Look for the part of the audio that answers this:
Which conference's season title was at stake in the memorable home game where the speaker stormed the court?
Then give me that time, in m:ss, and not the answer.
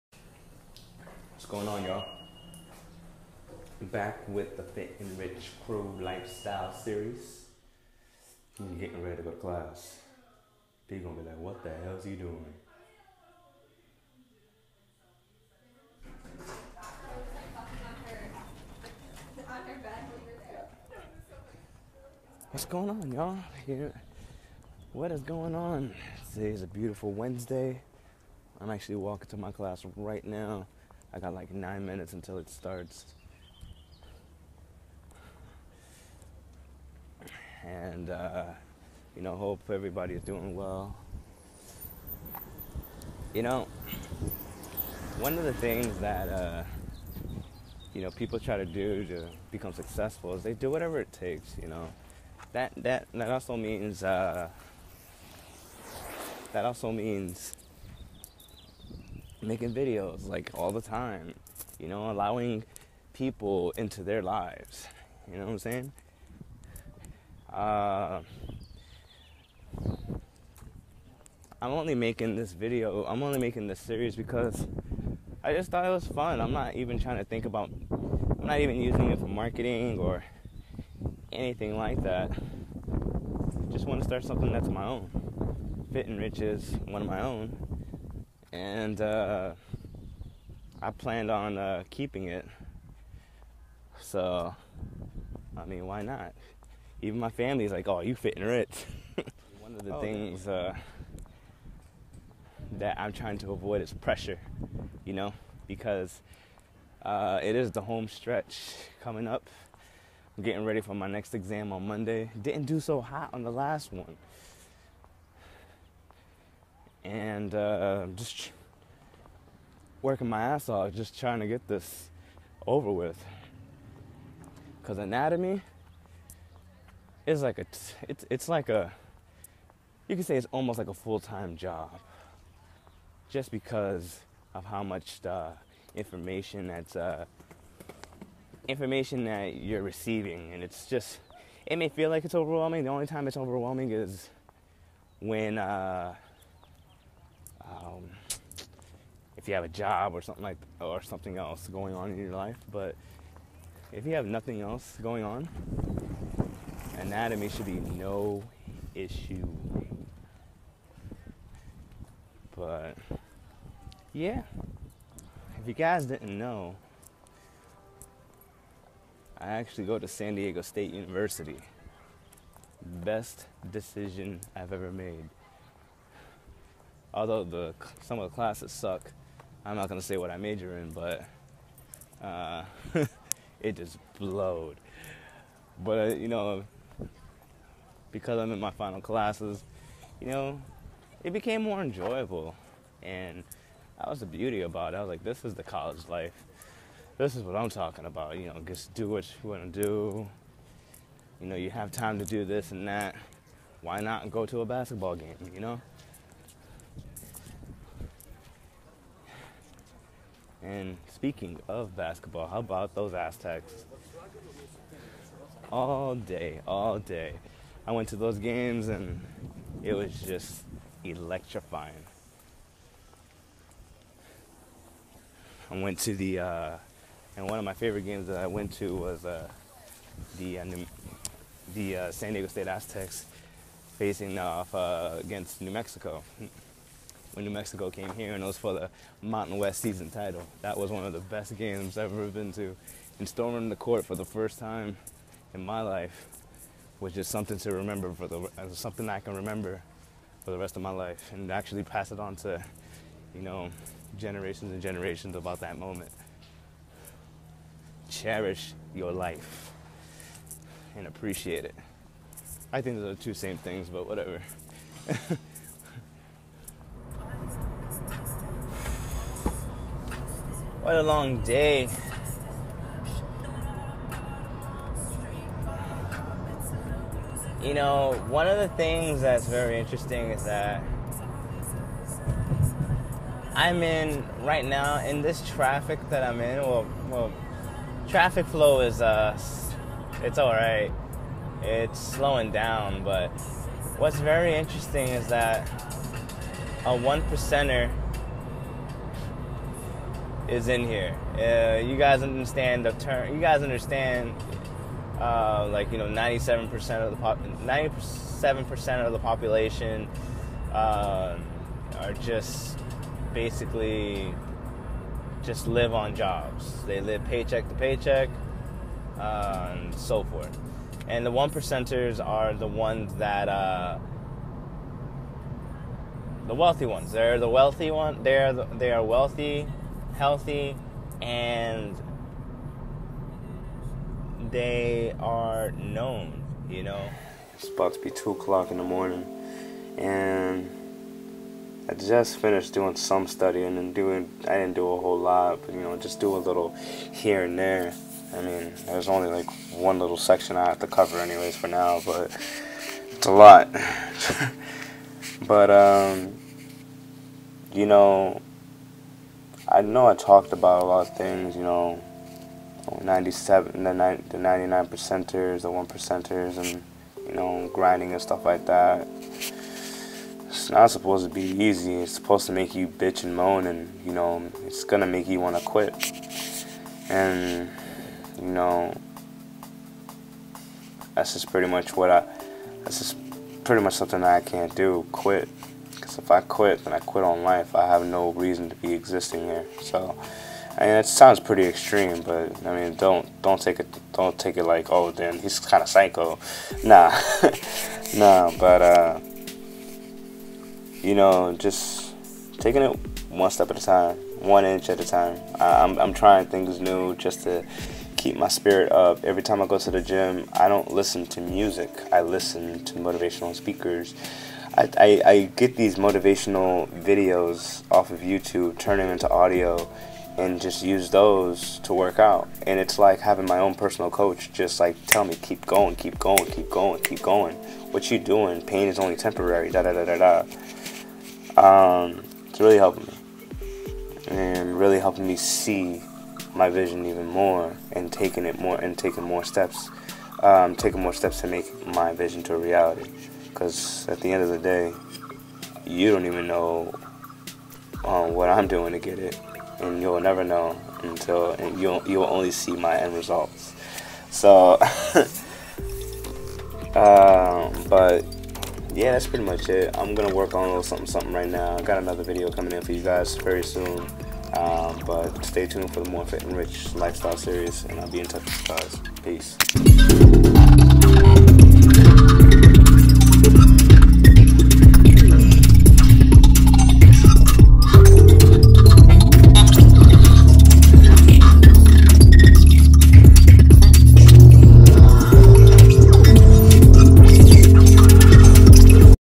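3:59.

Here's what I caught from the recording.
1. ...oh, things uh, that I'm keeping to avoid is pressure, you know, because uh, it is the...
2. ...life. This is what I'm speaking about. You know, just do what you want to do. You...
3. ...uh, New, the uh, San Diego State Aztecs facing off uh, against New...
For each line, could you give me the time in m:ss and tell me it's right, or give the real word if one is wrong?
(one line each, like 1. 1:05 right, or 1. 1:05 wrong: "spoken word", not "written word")
1. 1:39 wrong: "trying", not "keeping"
2. 3:16 wrong: "talking", not "speaking"
3. 3:50 right.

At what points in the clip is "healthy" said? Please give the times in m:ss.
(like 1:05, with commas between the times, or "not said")
5:30.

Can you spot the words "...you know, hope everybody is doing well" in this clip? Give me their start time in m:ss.
0:39.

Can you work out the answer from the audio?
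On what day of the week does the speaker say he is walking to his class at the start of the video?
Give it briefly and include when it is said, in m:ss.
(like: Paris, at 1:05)
Wednesday, at 0:27.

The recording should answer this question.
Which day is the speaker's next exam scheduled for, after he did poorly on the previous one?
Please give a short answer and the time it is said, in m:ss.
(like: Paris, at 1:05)
Monday, at 1:51.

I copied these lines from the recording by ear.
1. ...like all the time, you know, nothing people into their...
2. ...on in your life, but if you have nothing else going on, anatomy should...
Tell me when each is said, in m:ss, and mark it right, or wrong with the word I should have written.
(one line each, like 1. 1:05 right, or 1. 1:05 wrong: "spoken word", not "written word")
1. 1:00 wrong: "allowing", not "nothing"
2. 2:31 right.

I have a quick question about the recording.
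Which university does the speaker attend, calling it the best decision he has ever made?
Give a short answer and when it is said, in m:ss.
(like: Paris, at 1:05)
San Diego State University, at 2:50.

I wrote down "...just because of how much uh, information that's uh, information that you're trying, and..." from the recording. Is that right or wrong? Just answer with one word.
wrong.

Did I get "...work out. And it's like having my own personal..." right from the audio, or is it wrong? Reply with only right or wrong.
right.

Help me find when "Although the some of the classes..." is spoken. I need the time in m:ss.
2:57.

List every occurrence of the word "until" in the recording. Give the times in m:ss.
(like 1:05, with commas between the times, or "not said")
0:32, 7:31.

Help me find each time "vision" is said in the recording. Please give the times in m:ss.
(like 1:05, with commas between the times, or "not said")
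7:16, 7:22.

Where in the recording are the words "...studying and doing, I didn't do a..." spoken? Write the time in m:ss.
5:43.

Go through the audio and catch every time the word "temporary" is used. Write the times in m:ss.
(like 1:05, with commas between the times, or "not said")
7:09.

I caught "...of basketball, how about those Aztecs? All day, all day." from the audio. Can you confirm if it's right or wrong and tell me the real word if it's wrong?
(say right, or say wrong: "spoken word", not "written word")
right.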